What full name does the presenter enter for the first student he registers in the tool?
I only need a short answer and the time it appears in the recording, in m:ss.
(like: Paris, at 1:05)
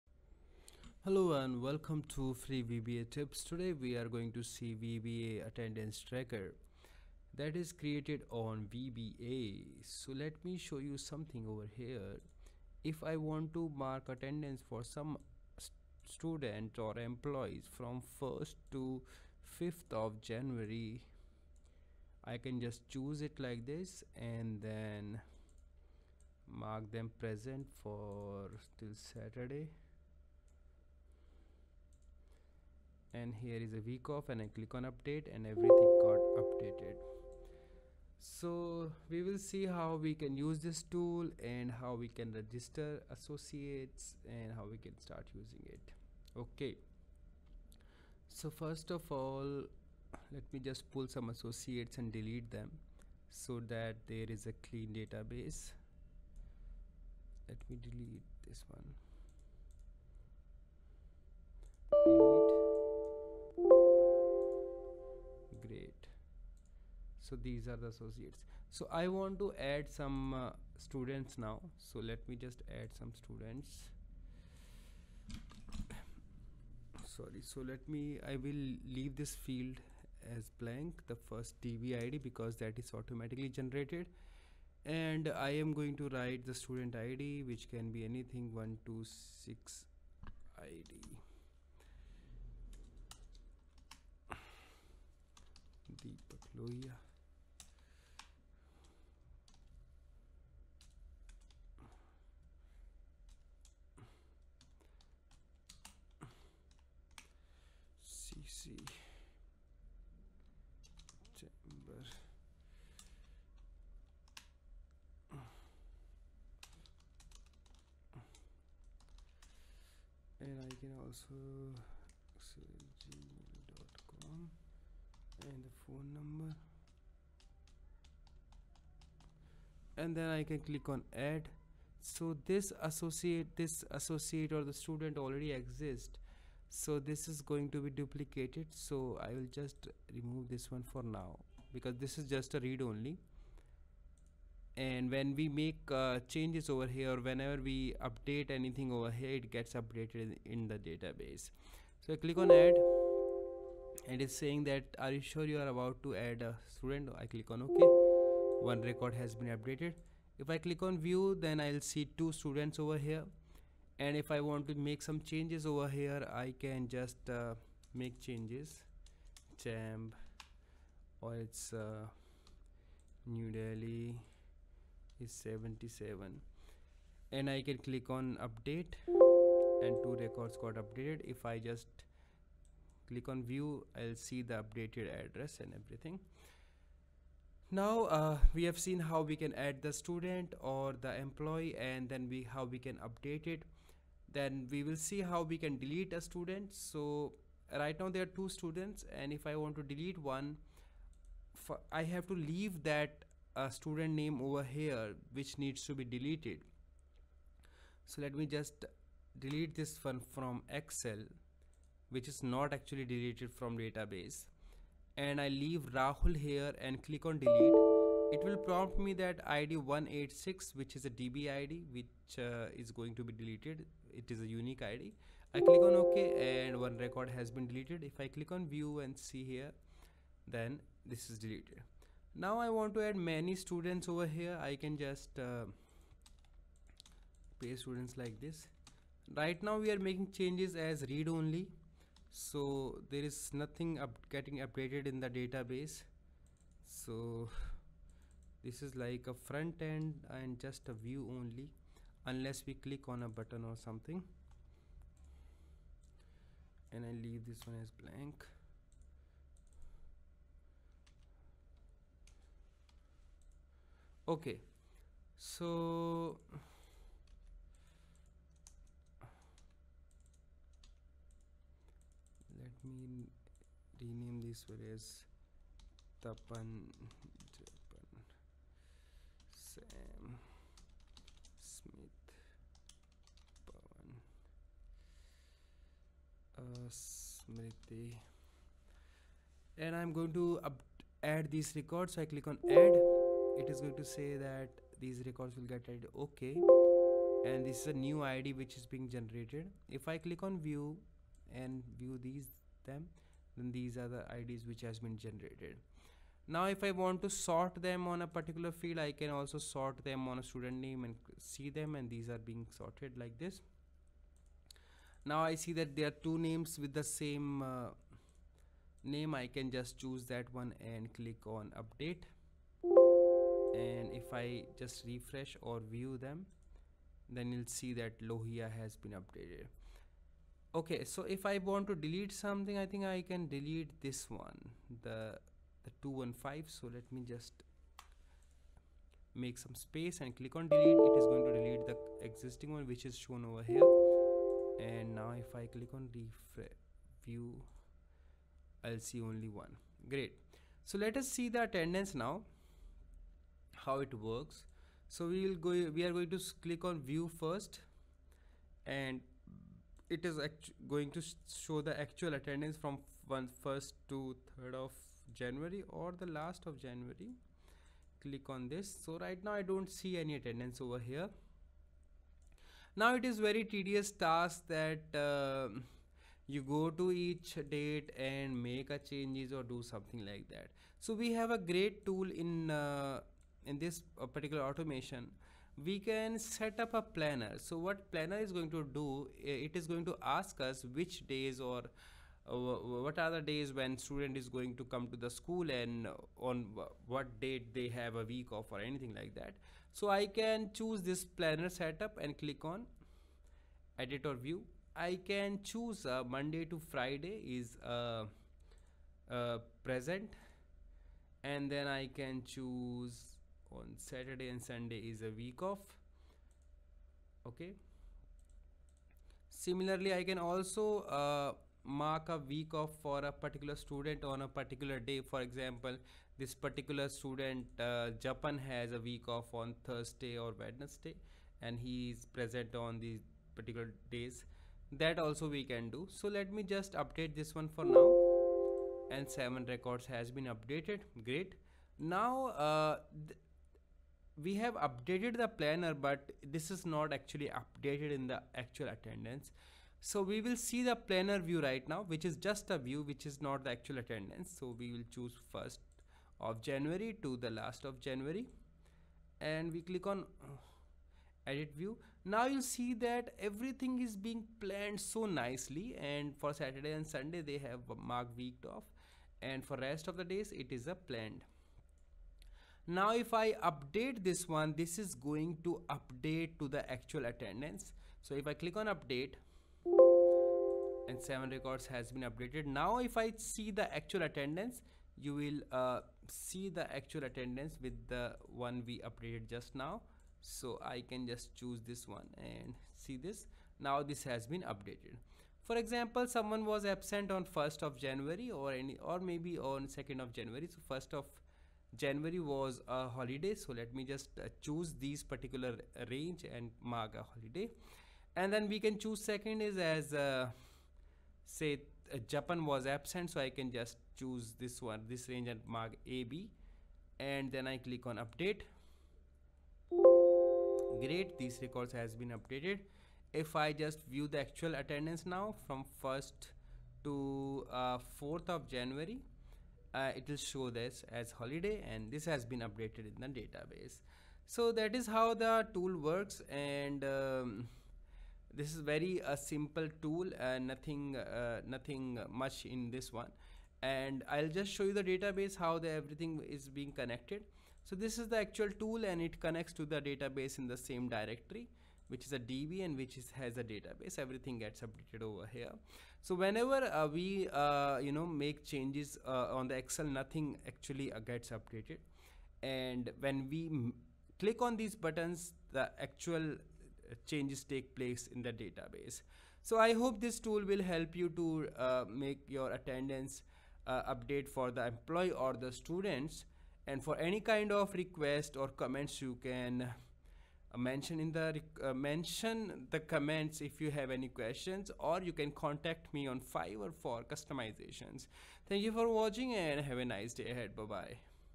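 Deepak Lohia, at 1:36.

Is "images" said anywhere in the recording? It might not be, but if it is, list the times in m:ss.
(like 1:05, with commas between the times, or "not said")
not said.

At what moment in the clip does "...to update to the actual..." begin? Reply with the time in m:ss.
7:55.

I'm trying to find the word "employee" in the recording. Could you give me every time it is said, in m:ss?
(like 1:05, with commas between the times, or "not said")
0:16, 3:11, 9:34.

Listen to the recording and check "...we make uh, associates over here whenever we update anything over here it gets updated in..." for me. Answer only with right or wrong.
wrong.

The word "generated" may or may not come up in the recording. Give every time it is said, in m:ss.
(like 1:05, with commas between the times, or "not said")
1:23, 4:59, 5:05.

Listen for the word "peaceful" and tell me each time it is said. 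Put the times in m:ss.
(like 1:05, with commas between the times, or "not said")
not said.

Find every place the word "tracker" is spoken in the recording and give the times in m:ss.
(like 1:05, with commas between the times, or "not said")
0:06.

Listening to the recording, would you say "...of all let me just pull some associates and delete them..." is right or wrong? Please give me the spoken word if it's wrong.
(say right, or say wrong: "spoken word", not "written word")
right.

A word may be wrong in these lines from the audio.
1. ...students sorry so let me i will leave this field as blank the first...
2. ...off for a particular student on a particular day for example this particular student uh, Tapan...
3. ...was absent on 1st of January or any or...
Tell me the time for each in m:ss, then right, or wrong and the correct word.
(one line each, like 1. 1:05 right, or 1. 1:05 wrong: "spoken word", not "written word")
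1. 1:13 right
2. 7:02 right
3. 8:16 right.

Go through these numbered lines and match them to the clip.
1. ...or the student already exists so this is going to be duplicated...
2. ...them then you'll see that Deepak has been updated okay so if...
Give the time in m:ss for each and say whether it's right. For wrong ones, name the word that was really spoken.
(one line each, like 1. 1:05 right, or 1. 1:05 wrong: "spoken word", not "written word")
1. 2:14 right
2. 5:26 wrong: "Lohia", not "Deepak".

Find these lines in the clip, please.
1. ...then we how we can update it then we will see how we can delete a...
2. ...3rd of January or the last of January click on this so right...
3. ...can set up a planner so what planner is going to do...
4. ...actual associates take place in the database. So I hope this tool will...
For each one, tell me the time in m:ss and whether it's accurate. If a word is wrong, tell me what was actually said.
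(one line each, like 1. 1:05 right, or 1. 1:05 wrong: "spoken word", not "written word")
1. 3:12 right
2. 6:04 right
3. 6:25 right
4. 9:25 wrong: "changes", not "associates".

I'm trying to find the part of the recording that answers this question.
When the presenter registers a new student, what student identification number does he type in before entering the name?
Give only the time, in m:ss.
1:28.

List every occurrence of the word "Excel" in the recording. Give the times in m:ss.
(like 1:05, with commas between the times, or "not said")
3:30, 9:19.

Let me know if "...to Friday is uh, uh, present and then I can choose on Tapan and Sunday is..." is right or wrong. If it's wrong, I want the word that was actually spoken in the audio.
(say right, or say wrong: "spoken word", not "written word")
wrong: "Saturday", not "Tapan".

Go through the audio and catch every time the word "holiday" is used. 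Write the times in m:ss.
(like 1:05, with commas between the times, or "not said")
8:23, 8:27, 8:51.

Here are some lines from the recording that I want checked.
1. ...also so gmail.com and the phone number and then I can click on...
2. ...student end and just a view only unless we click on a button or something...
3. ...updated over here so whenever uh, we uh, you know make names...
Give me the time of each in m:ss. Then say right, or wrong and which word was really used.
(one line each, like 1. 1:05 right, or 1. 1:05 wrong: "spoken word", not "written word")
1. 2:01 right
2. 4:09 wrong: "front", not "student"
3. 9:14 wrong: "changes", not "names".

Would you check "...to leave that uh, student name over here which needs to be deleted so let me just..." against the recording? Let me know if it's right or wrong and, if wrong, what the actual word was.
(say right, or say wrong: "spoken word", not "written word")
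right.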